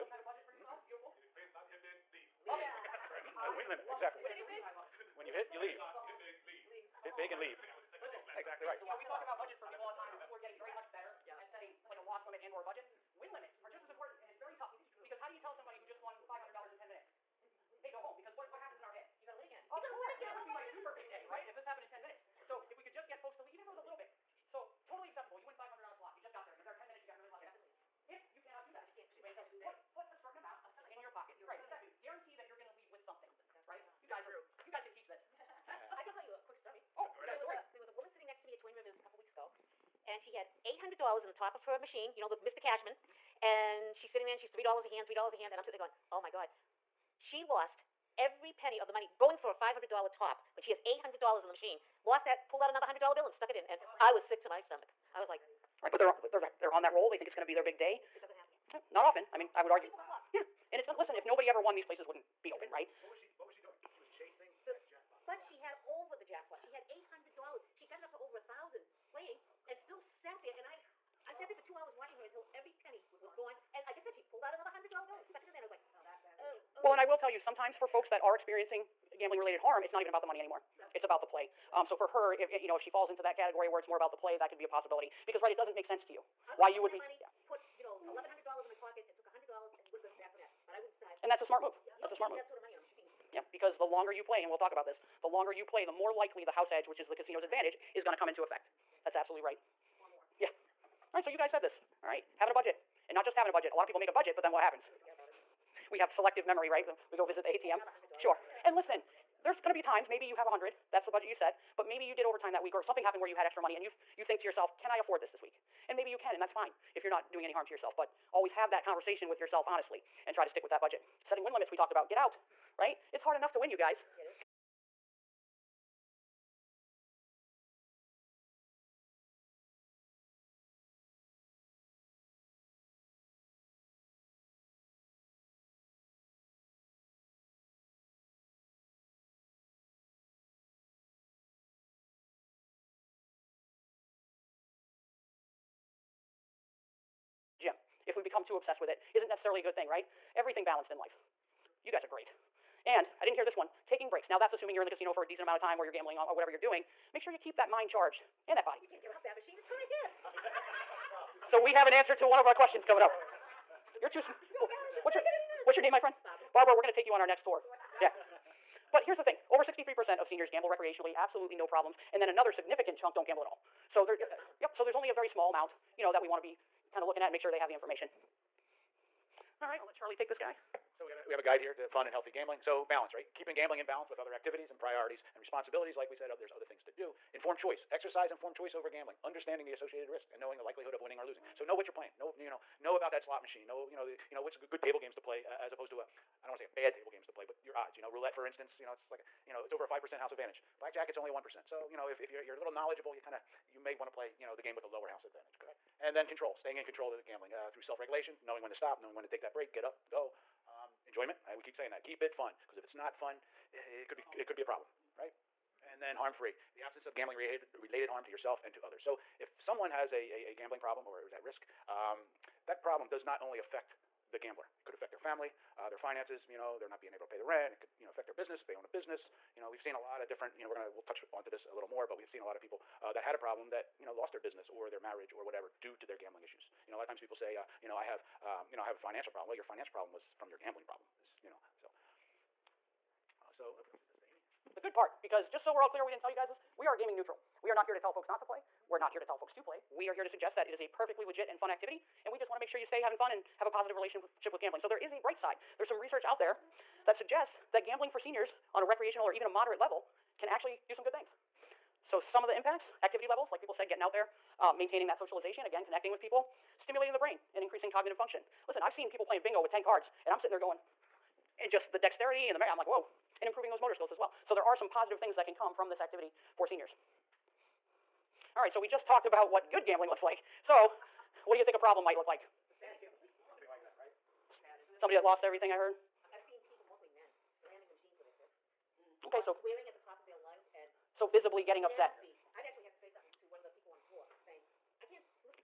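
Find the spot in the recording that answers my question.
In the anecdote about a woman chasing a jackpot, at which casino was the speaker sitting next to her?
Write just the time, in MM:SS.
00:38.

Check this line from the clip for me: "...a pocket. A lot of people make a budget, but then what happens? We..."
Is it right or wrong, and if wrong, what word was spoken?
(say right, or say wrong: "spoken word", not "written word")
wrong: "budget", not "pocket".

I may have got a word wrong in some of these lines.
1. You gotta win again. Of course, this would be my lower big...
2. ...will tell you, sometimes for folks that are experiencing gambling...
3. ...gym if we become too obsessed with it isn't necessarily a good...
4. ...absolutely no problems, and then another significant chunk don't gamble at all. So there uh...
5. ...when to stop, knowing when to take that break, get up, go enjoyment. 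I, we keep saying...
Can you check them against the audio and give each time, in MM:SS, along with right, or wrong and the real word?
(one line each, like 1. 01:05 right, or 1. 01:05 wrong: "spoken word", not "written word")
1. 00:19 wrong: "super", not "lower"
2. 01:17 right
3. 02:27 right
4. 02:51 right
5. 03:28 right.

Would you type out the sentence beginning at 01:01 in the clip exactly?
If nobody ever won, these places wouldn't be open, right?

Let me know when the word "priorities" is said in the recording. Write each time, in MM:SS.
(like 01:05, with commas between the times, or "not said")
03:04.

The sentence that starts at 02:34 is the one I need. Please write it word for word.
Now, that's assuming you're in the casino for a decent amount of time or you're gambling or whatever you're doing.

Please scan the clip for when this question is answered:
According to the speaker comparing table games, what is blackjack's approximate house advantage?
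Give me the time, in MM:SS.
03:21.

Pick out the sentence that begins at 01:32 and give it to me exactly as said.
That sort of money in a machine.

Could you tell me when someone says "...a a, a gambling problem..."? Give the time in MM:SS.
03:40.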